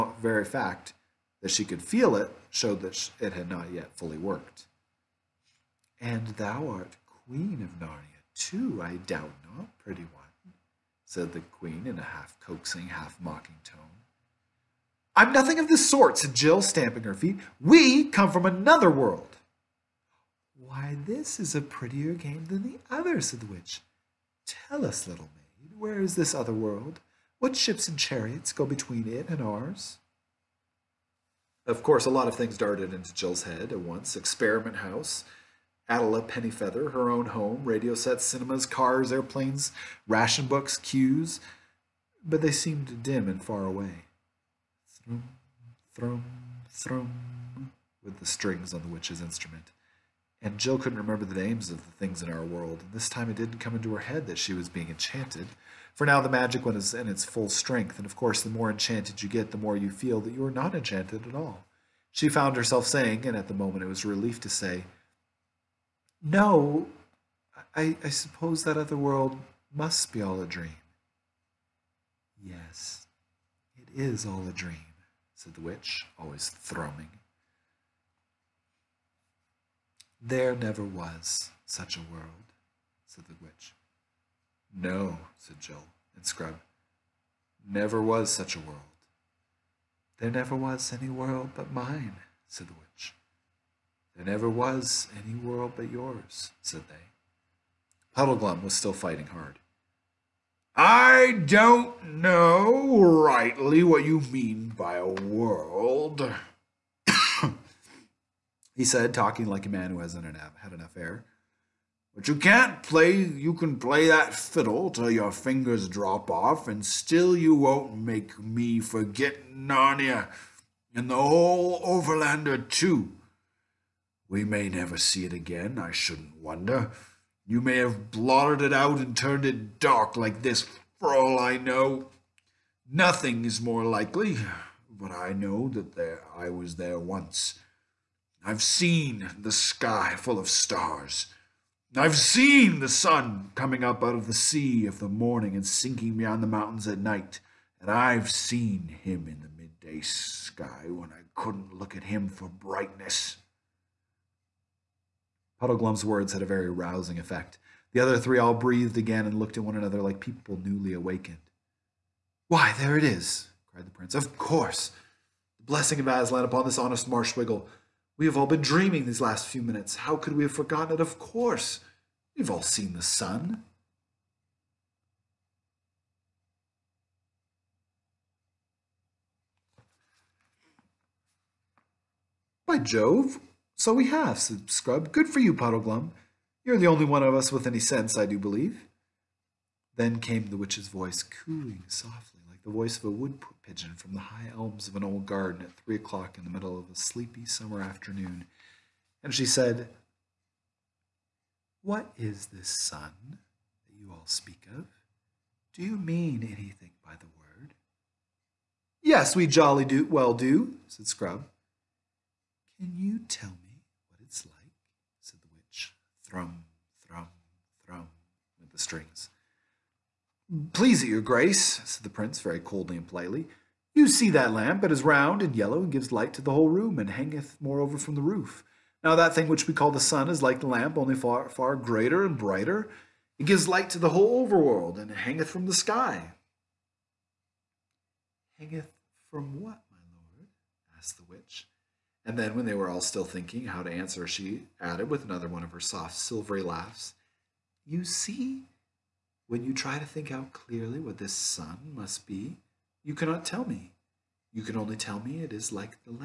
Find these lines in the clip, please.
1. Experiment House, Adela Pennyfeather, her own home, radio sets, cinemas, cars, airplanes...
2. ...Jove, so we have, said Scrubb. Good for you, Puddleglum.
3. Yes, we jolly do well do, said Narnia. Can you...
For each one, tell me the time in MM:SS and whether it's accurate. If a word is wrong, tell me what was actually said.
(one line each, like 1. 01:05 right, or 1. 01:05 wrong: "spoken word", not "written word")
1. 00:34 right
2. 03:02 right
3. 03:29 wrong: "Scrubb", not "Narnia".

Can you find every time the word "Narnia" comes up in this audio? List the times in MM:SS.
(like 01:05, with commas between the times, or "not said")
00:07, 01:59.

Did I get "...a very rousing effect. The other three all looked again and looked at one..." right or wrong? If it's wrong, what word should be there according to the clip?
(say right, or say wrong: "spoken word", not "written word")
wrong: "breathed", not "looked".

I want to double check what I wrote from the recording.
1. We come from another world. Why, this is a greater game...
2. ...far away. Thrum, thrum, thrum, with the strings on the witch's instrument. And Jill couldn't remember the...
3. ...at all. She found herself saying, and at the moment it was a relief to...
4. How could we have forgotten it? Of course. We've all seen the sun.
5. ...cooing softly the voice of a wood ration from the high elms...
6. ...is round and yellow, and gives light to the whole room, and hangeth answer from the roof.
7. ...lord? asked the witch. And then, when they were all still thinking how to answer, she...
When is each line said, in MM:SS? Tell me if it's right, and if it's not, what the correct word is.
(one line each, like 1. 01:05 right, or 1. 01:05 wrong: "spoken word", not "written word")
1. 00:17 wrong: "prettier", not "greater"
2. 00:43 right
3. 01:01 right
4. 02:49 right
5. 03:11 wrong: "pigeon", not "ration"
6. 03:44 wrong: "moreover", not "answer"
7. 04:00 right.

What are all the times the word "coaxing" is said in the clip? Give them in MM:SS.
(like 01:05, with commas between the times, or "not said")
00:12.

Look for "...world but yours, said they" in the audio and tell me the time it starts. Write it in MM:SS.
01:35.